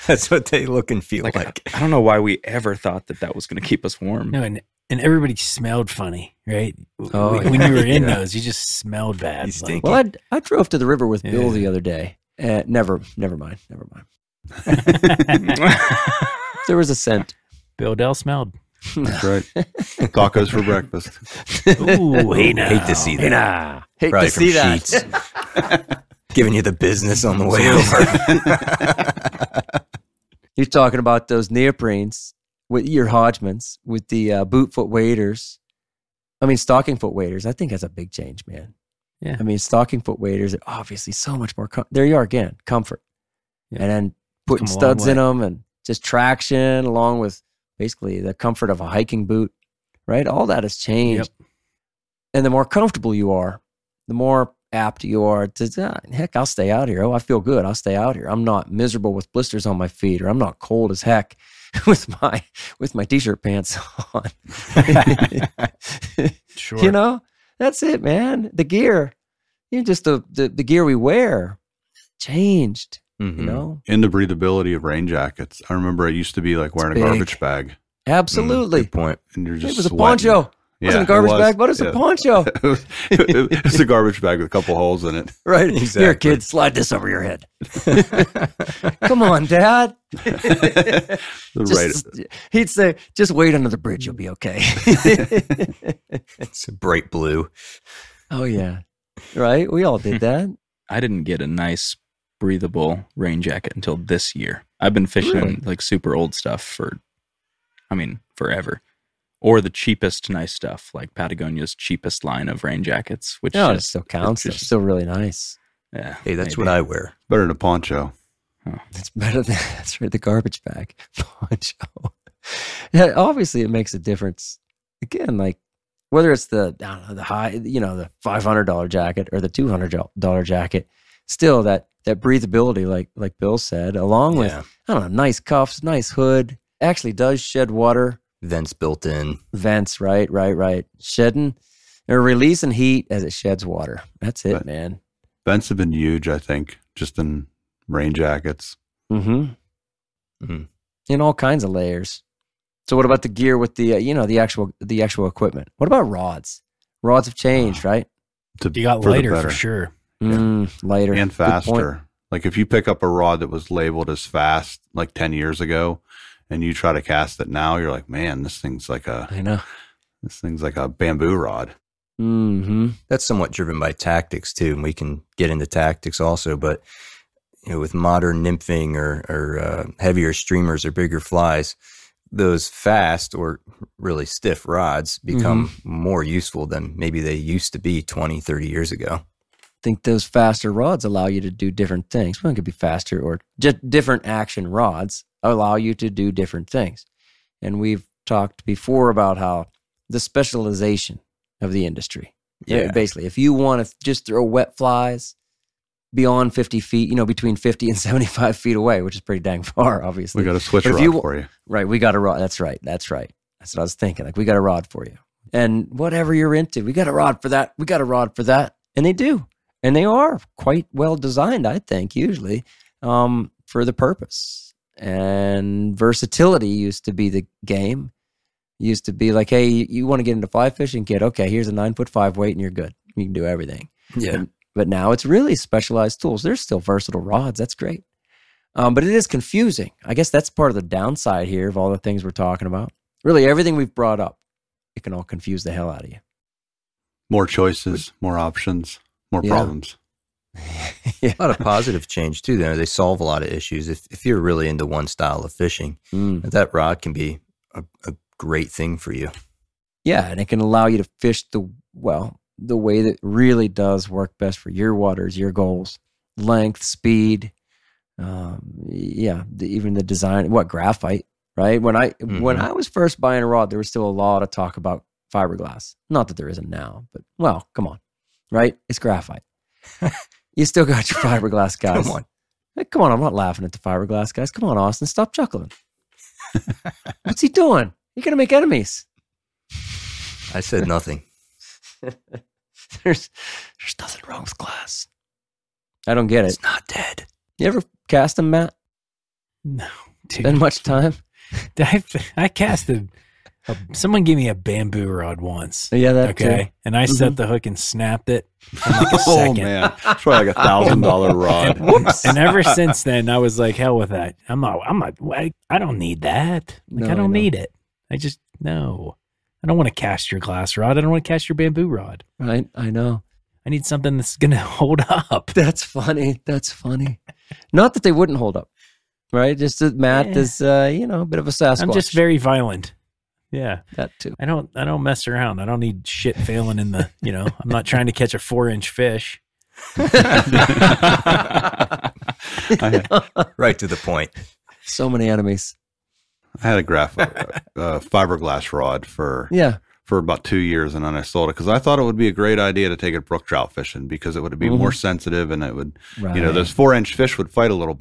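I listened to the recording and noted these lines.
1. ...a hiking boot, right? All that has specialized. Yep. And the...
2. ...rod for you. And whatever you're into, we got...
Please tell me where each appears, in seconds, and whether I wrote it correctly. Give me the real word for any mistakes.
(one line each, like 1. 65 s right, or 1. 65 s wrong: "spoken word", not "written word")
1. 48 s wrong: "changed", not "specialized"
2. 214 s right.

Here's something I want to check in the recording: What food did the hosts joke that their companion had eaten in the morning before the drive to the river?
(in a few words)
Tacos.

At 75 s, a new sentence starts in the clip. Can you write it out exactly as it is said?
I remember I used to be like wearing a garbage bag.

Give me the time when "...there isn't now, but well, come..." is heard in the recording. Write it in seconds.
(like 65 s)
276 s.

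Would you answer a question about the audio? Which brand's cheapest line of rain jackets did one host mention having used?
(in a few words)
Patagonia.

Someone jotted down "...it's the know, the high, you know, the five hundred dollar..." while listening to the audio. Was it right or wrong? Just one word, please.
right.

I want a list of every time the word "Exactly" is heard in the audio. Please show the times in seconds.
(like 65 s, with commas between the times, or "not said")
85 s.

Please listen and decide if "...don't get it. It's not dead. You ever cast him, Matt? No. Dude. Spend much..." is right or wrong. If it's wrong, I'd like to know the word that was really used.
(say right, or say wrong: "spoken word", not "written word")
right.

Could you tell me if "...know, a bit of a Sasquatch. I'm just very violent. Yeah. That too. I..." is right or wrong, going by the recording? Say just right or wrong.
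right.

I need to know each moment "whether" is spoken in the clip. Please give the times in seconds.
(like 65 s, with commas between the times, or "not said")
126 s.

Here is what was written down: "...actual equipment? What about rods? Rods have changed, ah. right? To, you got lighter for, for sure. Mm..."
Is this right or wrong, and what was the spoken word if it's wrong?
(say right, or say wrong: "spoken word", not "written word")
right.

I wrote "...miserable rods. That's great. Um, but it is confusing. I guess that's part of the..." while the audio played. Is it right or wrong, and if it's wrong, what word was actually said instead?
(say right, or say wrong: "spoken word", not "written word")
wrong: "versatile", not "miserable".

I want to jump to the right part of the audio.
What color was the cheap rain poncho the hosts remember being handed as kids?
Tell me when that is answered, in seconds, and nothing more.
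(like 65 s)
96 s.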